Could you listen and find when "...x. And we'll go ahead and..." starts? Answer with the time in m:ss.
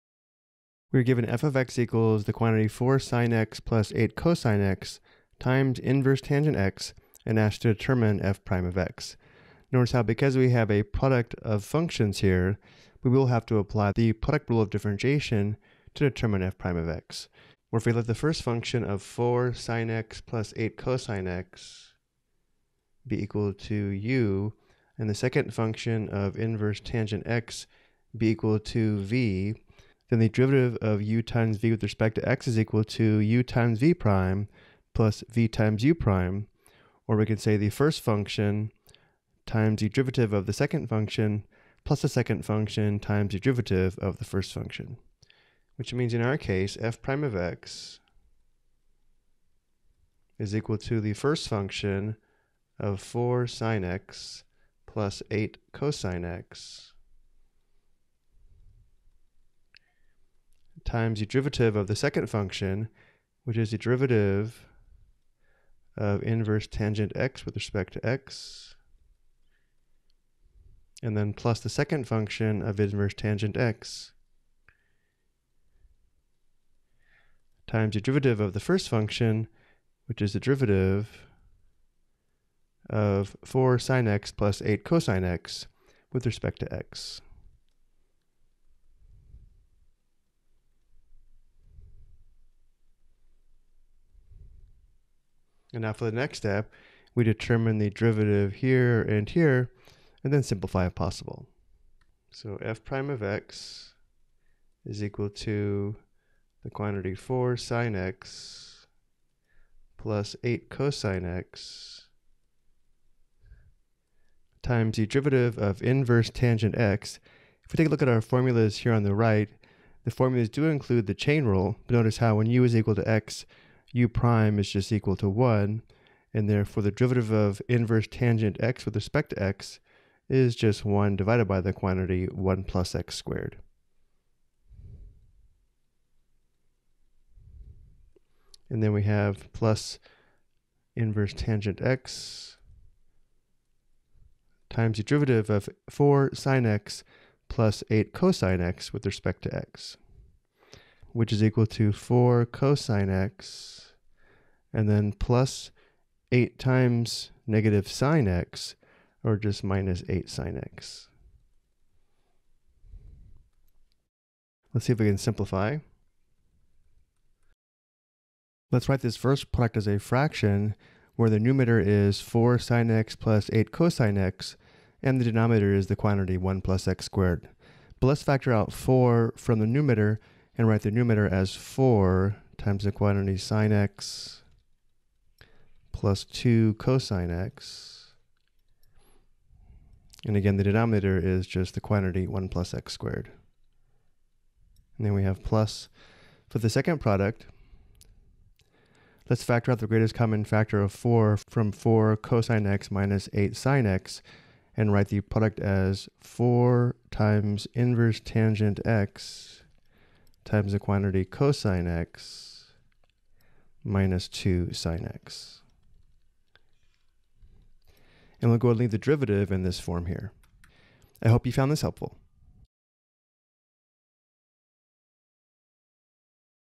3:35.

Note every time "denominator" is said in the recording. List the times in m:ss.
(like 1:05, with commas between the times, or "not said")
2:55, 3:10.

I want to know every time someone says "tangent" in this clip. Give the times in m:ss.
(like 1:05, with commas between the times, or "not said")
0:06, 0:26, 1:06, 1:13, 1:56, 2:08, 2:21, 3:28.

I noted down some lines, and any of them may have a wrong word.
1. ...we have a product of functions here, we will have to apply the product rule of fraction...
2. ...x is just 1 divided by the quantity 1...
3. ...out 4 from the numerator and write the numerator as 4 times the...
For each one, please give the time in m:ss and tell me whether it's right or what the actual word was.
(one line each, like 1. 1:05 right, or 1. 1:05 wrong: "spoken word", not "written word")
1. 0:10 wrong: "differentiation", not "fraction"
2. 2:09 right
3. 2:58 right.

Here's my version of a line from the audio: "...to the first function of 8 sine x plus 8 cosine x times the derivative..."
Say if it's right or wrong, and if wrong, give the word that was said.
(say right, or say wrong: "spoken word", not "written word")
wrong: "4", not "8".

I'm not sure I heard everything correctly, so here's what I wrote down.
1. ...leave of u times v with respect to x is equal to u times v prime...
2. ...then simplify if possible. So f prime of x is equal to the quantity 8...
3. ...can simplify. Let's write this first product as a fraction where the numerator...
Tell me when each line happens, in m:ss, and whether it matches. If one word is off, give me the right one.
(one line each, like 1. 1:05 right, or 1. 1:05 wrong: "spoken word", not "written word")
1. 0:30 wrong: "derivative", not "leave"
2. 1:40 wrong: "4", not "8"
3. 2:45 right.